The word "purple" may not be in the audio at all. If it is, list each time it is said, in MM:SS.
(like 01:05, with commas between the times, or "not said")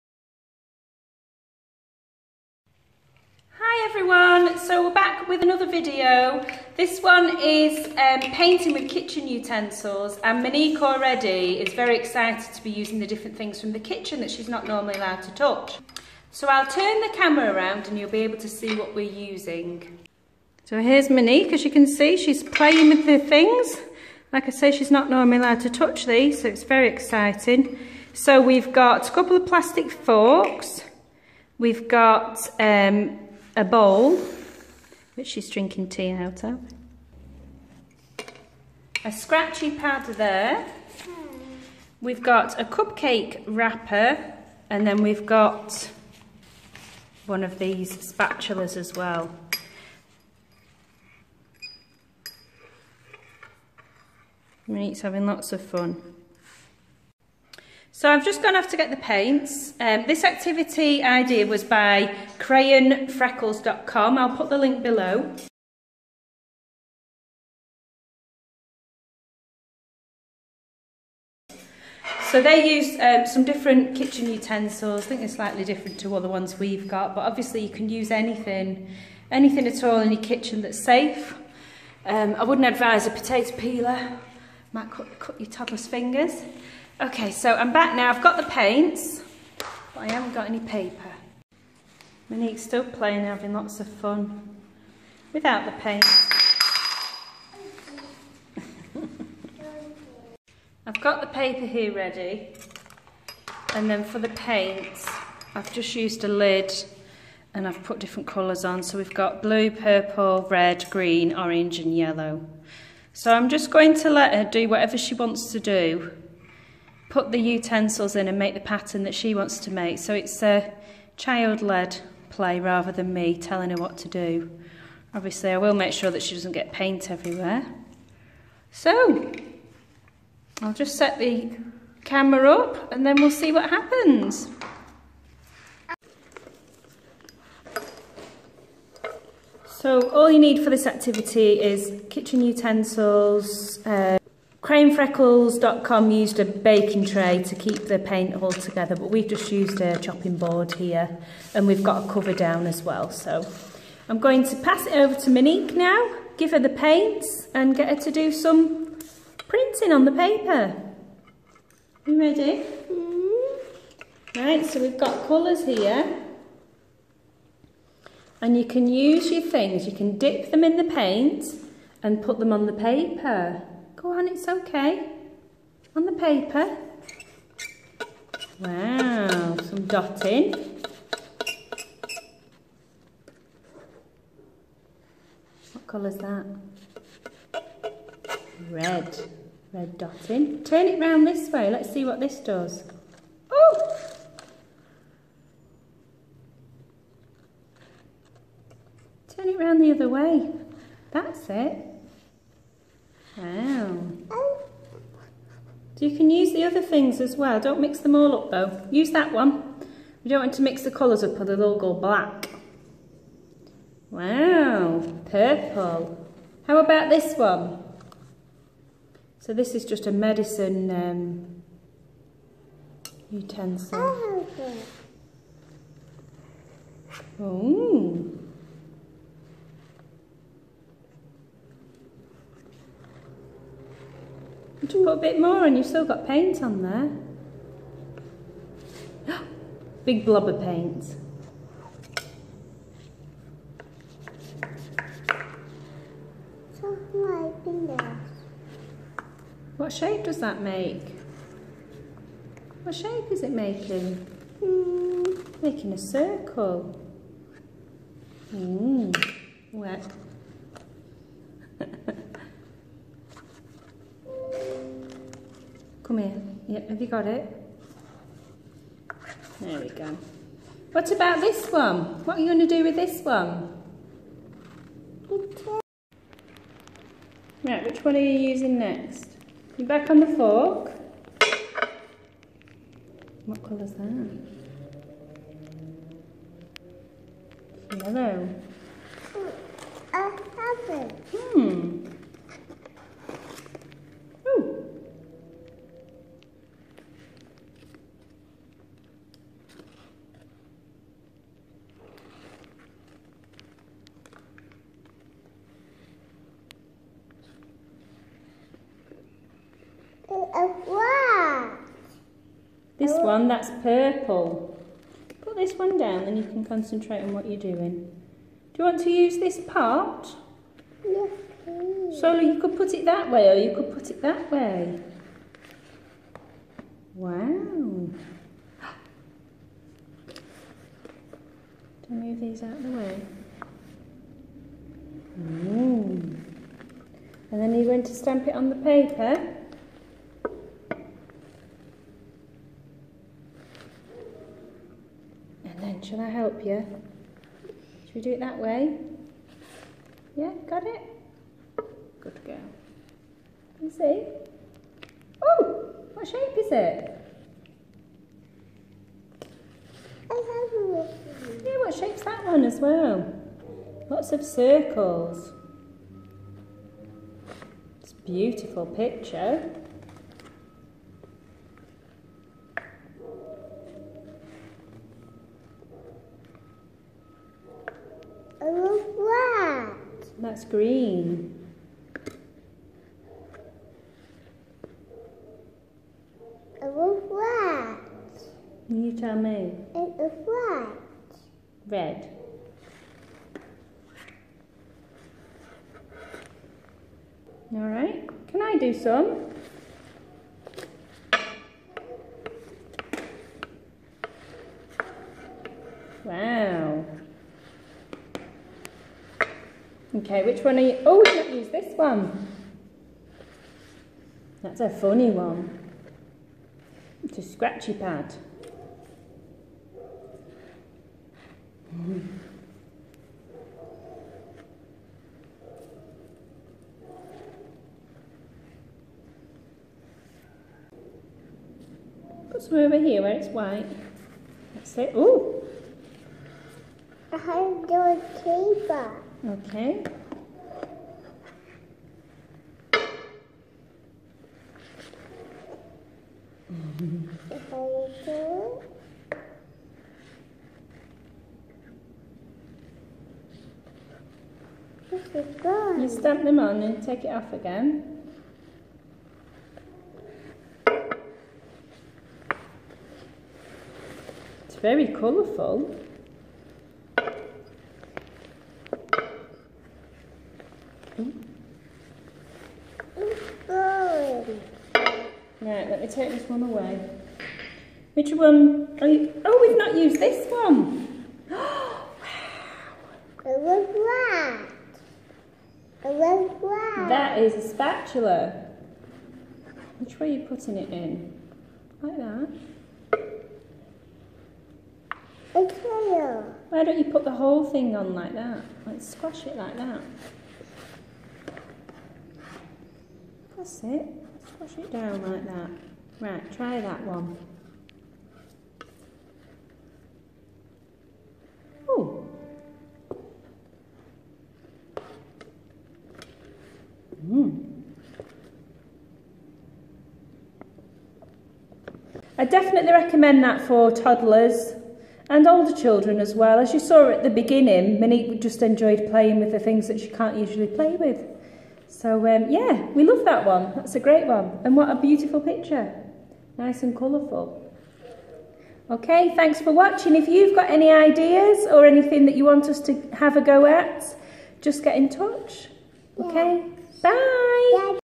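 01:49, 03:35, 05:13.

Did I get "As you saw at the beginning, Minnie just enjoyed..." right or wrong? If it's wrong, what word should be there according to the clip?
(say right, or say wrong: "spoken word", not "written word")
right.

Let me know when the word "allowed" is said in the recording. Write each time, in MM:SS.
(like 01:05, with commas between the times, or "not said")
00:14, 00:25.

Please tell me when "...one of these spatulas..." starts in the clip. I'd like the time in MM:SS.
00:47.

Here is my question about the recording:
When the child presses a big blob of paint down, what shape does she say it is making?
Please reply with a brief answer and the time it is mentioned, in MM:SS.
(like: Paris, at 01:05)
A circle, at 04:15.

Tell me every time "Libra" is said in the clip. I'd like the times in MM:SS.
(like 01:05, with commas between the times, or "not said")
not said.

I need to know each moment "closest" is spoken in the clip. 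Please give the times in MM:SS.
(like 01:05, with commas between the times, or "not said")
not said.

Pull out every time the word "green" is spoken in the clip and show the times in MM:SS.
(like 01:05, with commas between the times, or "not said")
01:50, 06:20.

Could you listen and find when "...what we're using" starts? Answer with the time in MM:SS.
00:18.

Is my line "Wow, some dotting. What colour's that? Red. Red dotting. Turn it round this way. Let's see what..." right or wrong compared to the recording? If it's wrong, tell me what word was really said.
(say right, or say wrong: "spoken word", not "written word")
right.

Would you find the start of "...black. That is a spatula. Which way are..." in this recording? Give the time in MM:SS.
08:06.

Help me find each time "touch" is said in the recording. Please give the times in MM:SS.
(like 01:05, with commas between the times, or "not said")
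00:15, 00:25, 09:05.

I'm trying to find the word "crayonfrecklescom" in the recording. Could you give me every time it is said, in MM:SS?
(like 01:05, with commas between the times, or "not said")
01:02, 02:24.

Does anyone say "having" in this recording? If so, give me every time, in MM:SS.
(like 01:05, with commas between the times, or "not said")
00:55, 01:33.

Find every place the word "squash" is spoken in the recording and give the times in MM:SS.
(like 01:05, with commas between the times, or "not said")
08:19, 08:24.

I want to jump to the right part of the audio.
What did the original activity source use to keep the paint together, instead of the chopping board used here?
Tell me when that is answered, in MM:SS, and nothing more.
02:26.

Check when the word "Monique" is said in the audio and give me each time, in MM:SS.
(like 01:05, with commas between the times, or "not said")
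00:10, 00:21, 01:32, 02:35.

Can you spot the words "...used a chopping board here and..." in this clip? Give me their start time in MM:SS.
02:29.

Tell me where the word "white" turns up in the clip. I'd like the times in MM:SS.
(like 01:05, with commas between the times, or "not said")
07:13.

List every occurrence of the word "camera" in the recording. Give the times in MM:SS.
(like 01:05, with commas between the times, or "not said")
00:17, 02:12.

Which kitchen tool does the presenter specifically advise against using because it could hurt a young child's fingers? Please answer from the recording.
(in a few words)
Potato peeler.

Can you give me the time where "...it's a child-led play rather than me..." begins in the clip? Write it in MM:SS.
02:00.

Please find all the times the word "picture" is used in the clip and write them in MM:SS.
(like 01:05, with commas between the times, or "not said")
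06:08, 08:55.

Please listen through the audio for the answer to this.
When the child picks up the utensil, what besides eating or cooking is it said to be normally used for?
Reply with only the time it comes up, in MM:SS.
03:40.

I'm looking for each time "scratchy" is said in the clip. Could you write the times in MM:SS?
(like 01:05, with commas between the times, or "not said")
00:39, 06:57.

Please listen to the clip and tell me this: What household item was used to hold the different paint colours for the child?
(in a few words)
A lid.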